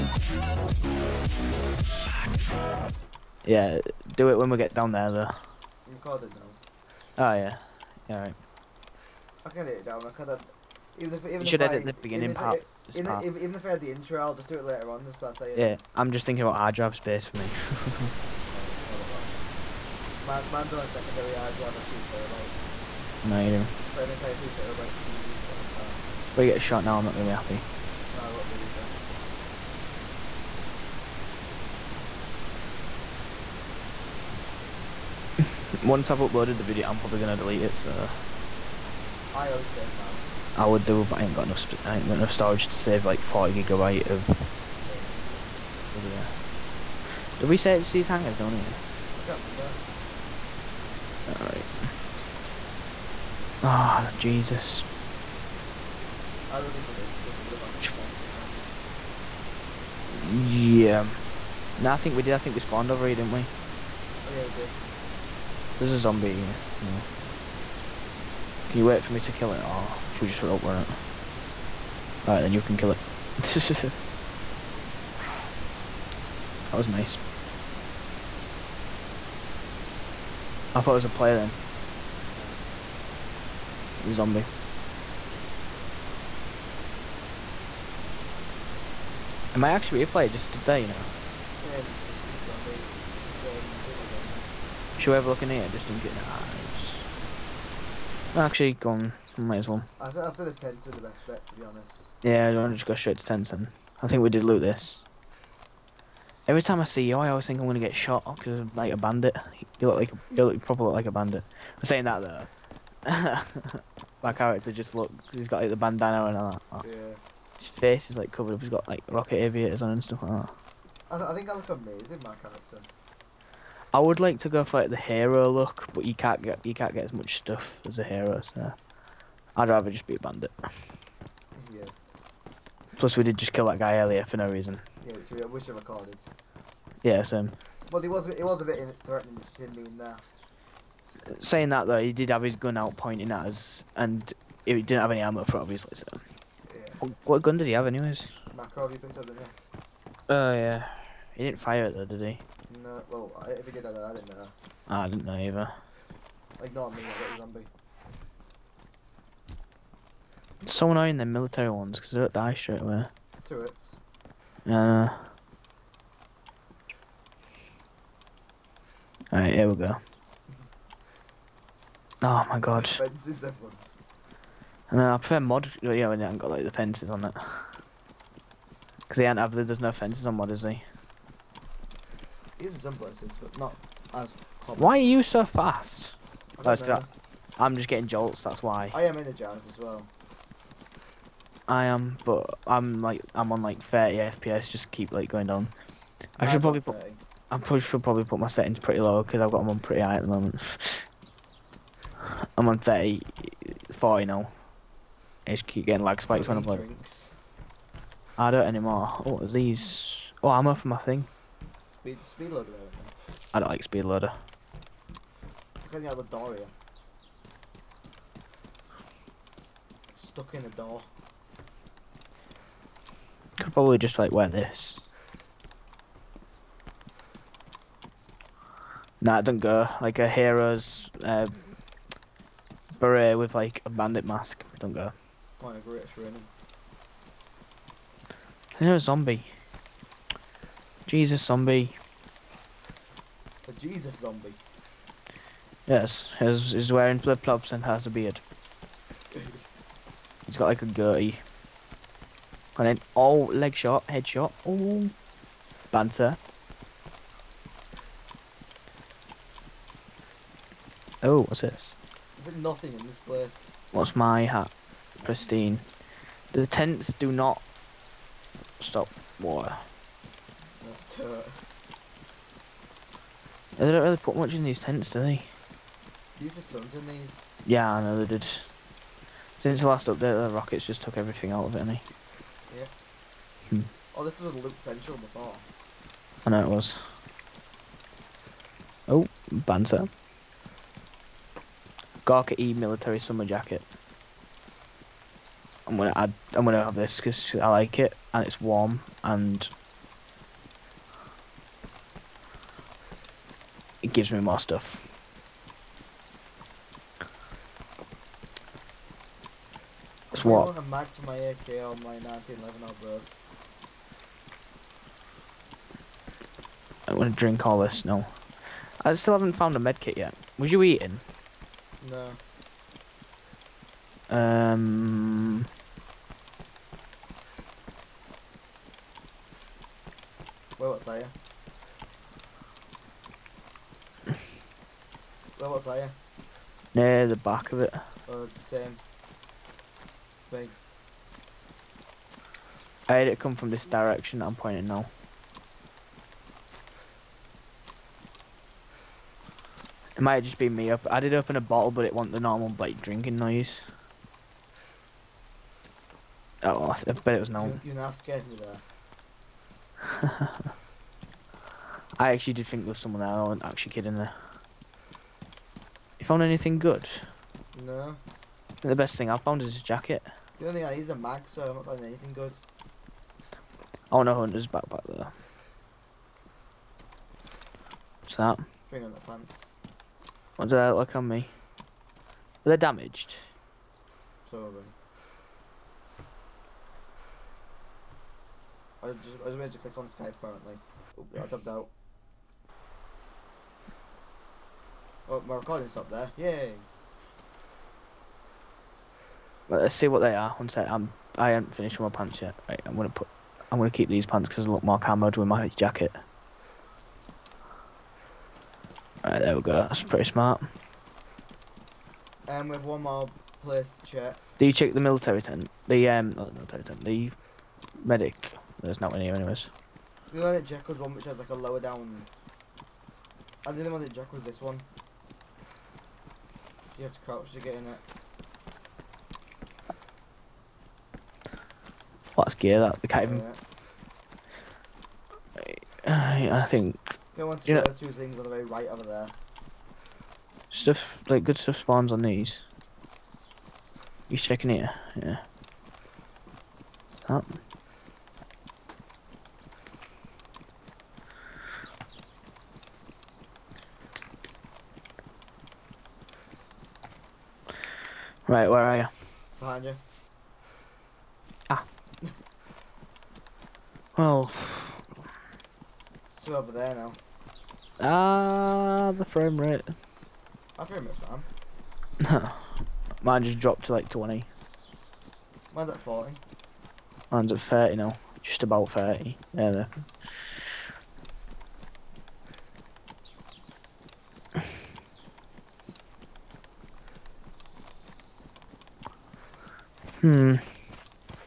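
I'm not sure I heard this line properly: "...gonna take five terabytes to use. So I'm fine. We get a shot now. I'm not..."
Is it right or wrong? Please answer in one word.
wrong.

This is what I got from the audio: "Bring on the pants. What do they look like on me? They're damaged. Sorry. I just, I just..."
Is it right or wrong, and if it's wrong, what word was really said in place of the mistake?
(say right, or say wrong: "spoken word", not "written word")
right.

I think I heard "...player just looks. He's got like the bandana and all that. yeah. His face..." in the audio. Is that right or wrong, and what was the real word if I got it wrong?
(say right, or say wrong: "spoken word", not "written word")
wrong: "character", not "player".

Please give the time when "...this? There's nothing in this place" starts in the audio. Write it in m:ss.
4:21.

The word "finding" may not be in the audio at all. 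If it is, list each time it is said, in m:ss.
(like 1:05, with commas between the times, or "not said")
6:11.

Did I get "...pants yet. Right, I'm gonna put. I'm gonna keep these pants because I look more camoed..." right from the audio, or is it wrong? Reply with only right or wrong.
right.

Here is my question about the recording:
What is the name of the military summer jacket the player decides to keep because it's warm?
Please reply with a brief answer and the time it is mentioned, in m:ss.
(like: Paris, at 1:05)
Gorka E, at 4:52.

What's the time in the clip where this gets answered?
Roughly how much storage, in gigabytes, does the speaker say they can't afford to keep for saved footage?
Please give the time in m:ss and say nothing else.
0:43.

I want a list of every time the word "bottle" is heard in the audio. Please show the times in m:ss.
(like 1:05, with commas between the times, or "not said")
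5:51.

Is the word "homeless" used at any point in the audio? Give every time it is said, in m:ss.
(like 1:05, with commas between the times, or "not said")
not said.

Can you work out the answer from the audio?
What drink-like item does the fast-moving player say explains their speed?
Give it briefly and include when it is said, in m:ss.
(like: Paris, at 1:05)
jolts, at 3:08.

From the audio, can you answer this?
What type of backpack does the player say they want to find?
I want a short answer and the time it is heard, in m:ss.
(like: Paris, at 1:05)
hunter's backpack, at 6:14.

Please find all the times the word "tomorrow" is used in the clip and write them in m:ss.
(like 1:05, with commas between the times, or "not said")
not said.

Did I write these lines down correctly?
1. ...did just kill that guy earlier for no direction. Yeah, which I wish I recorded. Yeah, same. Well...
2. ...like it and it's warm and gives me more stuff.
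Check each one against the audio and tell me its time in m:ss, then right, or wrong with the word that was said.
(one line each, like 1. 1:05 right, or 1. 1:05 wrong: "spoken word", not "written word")
1. 2:13 wrong: "reason", not "direction"
2. 4:57 right.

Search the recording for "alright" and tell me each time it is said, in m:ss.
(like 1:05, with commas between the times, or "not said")
0:08, 0:51, 1:12, 2:49.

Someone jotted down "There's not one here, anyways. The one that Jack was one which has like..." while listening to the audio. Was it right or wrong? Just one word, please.
right.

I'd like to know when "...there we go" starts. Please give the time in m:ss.
6:49.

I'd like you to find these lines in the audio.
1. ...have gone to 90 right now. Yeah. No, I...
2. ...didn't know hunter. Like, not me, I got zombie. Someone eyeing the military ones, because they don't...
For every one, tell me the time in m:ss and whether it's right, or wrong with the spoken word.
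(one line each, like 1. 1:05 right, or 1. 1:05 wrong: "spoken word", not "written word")
1. 0:57 wrong: "10", not "90"
2. 2:35 wrong: "either", not "hunter".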